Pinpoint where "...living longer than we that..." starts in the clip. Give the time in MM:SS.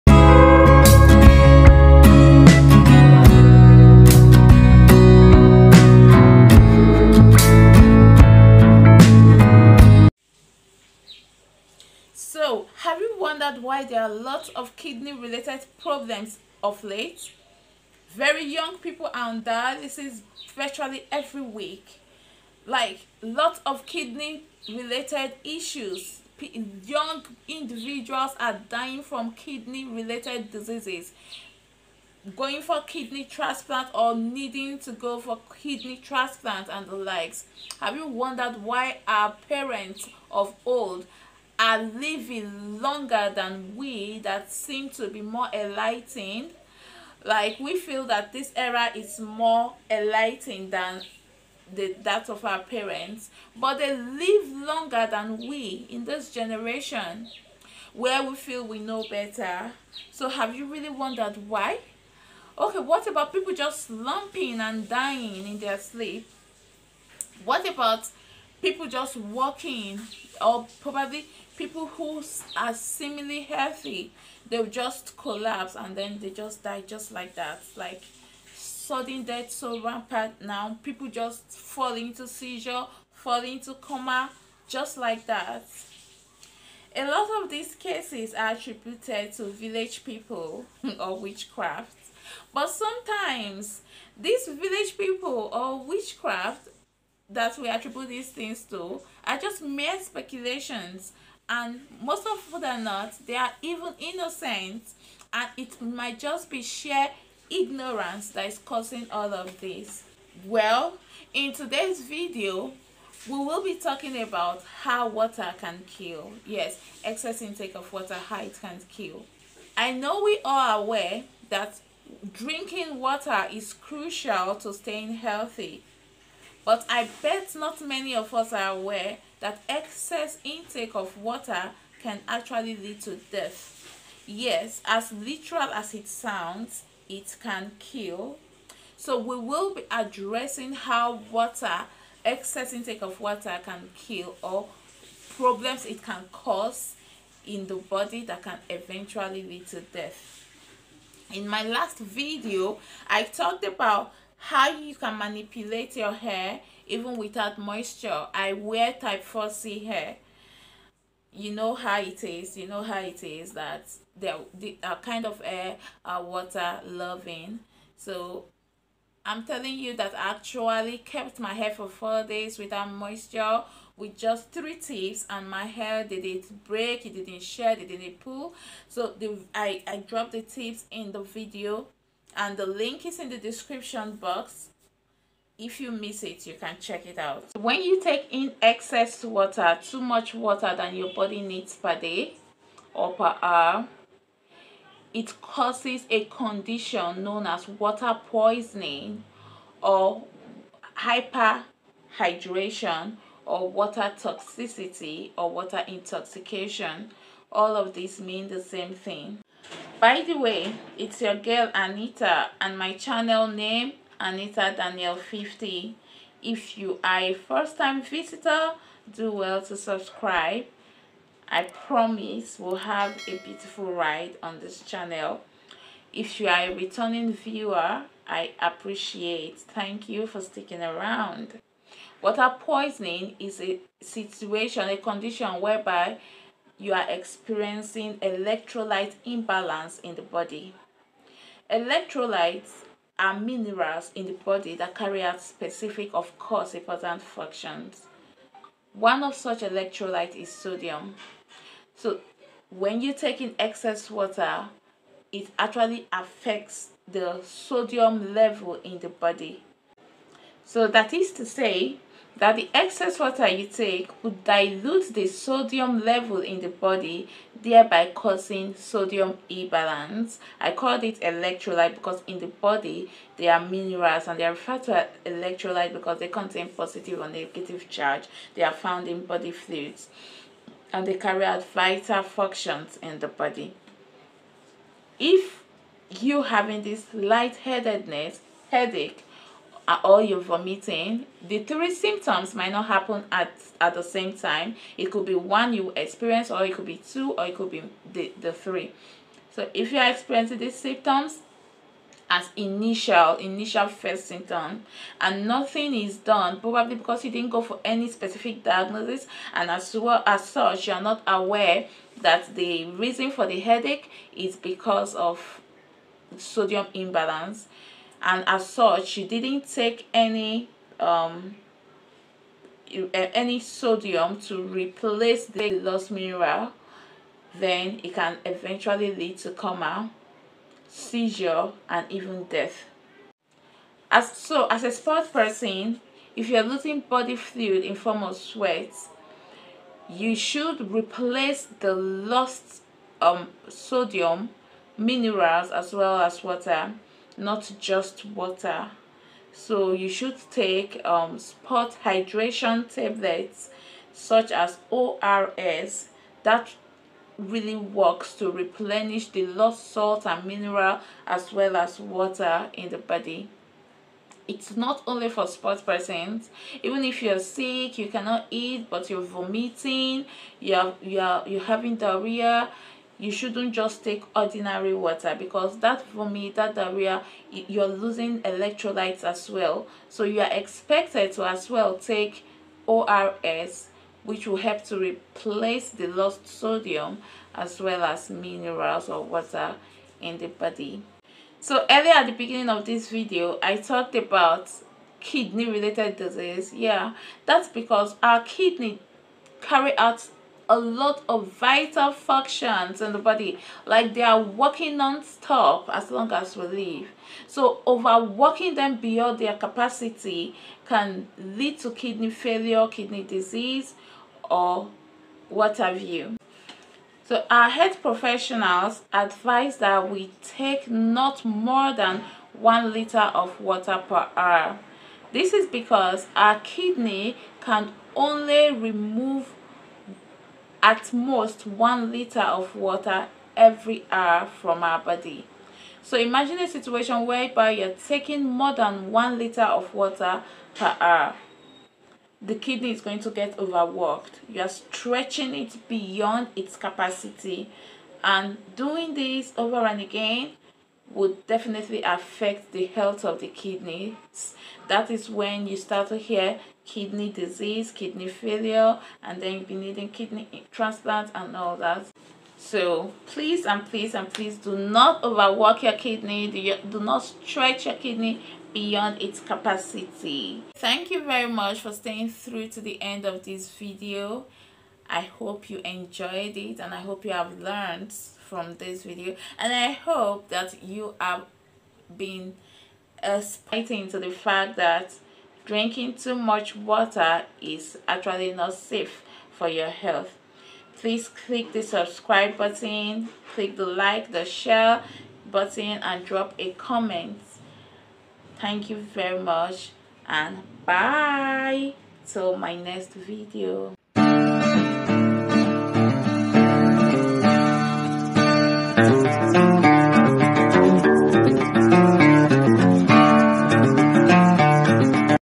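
00:41.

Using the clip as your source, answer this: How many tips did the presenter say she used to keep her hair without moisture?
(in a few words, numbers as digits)
3.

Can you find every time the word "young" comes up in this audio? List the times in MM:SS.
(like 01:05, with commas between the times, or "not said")
00:18, 00:26.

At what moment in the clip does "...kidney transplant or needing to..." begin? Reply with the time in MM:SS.
00:32.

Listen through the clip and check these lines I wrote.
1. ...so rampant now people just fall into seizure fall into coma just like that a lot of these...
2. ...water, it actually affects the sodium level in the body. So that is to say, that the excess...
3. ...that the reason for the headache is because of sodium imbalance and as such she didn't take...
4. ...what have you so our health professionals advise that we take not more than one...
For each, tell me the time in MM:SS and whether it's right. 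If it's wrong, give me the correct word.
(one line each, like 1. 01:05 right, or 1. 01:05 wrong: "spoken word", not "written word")
1. 01:19 right
2. 04:14 right
3. 05:12 right
4. 06:55 right.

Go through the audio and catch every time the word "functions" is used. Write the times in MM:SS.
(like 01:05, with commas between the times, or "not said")
04:07, 04:42, 06:42.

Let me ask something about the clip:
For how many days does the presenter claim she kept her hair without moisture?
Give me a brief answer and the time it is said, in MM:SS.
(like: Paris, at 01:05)
4, at 02:51.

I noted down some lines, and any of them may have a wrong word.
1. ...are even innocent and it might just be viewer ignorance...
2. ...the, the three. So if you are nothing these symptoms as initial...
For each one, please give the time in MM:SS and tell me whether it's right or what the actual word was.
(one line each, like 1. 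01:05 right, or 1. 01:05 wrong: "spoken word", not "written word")
1. 01:43 wrong: "sheer", not "viewer"
2. 04:58 wrong: "experiencing", not "nothing".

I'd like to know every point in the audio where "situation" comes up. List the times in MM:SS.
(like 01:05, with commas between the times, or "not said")
03:54, 07:16.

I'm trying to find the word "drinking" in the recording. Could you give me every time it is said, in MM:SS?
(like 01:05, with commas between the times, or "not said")
02:02, 08:05.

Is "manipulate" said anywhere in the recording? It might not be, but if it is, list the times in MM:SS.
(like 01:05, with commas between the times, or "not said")
02:35.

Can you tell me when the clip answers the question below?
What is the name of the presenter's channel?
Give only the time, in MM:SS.
03:34.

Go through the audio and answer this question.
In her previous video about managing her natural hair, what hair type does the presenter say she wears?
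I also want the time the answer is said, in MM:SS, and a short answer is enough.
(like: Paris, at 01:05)
type 4c, at 02:38.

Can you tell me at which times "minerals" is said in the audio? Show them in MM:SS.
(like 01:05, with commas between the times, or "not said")
04:03, 04:33, 05:26, 05:44, 06:00, 06:28.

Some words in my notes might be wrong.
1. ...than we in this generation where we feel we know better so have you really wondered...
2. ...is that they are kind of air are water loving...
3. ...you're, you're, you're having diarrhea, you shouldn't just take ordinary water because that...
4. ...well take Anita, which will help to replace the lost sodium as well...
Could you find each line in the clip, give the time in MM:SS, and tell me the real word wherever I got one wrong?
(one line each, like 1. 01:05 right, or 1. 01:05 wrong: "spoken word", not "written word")
1. 00:55 right
2. 02:43 right
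3. 06:10 right
4. 06:21 wrong: "ORS", not "Anita".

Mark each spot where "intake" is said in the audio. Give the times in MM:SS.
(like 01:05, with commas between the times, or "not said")
01:57, 02:10, 02:22.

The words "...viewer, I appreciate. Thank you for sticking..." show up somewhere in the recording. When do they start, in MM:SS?
03:47.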